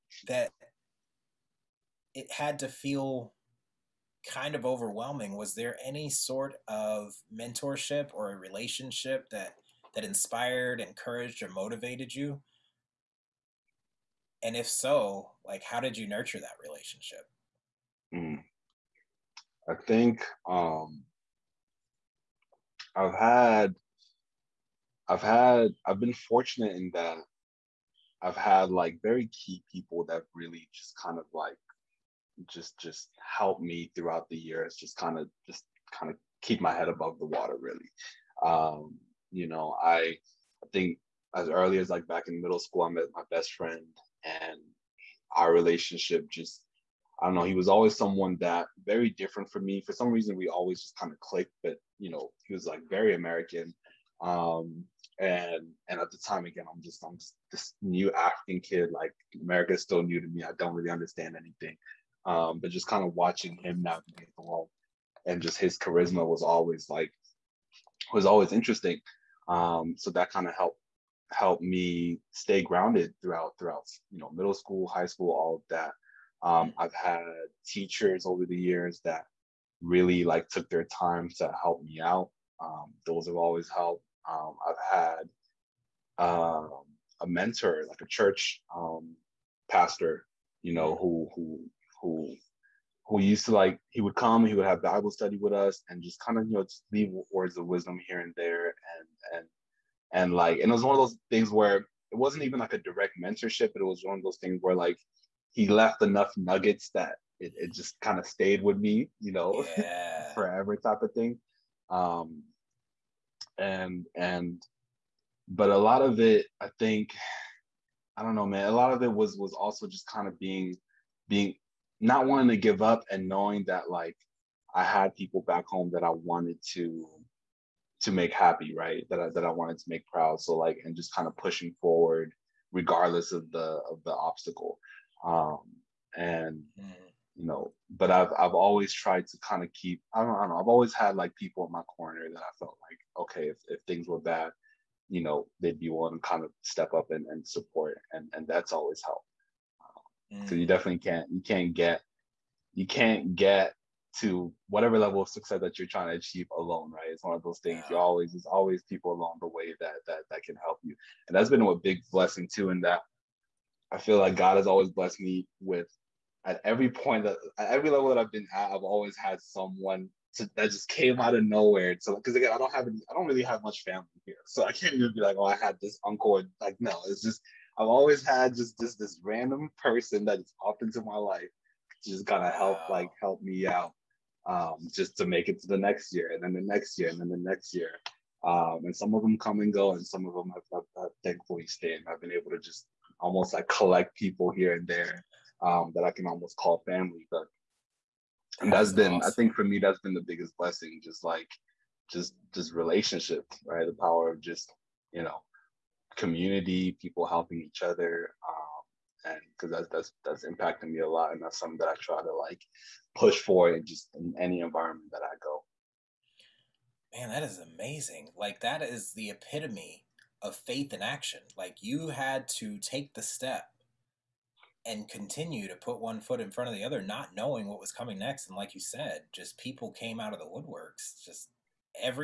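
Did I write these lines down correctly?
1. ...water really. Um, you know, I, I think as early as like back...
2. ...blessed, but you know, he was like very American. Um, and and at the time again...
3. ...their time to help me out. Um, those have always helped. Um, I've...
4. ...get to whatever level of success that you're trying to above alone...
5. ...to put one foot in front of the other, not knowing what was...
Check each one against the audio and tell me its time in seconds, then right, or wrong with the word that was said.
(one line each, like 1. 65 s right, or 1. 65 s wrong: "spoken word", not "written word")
1. 37 s right
2. 51 s wrong: "clicked", not "blessed"
3. 80 s right
4. 153 s wrong: "achieve", not "above"
5. 225 s right.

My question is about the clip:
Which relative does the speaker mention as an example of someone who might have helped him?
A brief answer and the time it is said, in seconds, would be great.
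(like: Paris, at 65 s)
Uncle, at 176 s.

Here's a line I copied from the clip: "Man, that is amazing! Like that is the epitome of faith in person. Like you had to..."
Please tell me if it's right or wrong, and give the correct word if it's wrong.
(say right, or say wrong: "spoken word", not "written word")
wrong: "action", not "person".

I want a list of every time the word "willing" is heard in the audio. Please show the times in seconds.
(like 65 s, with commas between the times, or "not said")
145 s.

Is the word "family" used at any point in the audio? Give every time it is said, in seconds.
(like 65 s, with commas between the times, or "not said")
173 s, 196 s.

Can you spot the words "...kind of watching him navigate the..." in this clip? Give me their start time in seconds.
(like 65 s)
62 s.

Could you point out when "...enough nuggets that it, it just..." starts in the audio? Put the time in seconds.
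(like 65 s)
106 s.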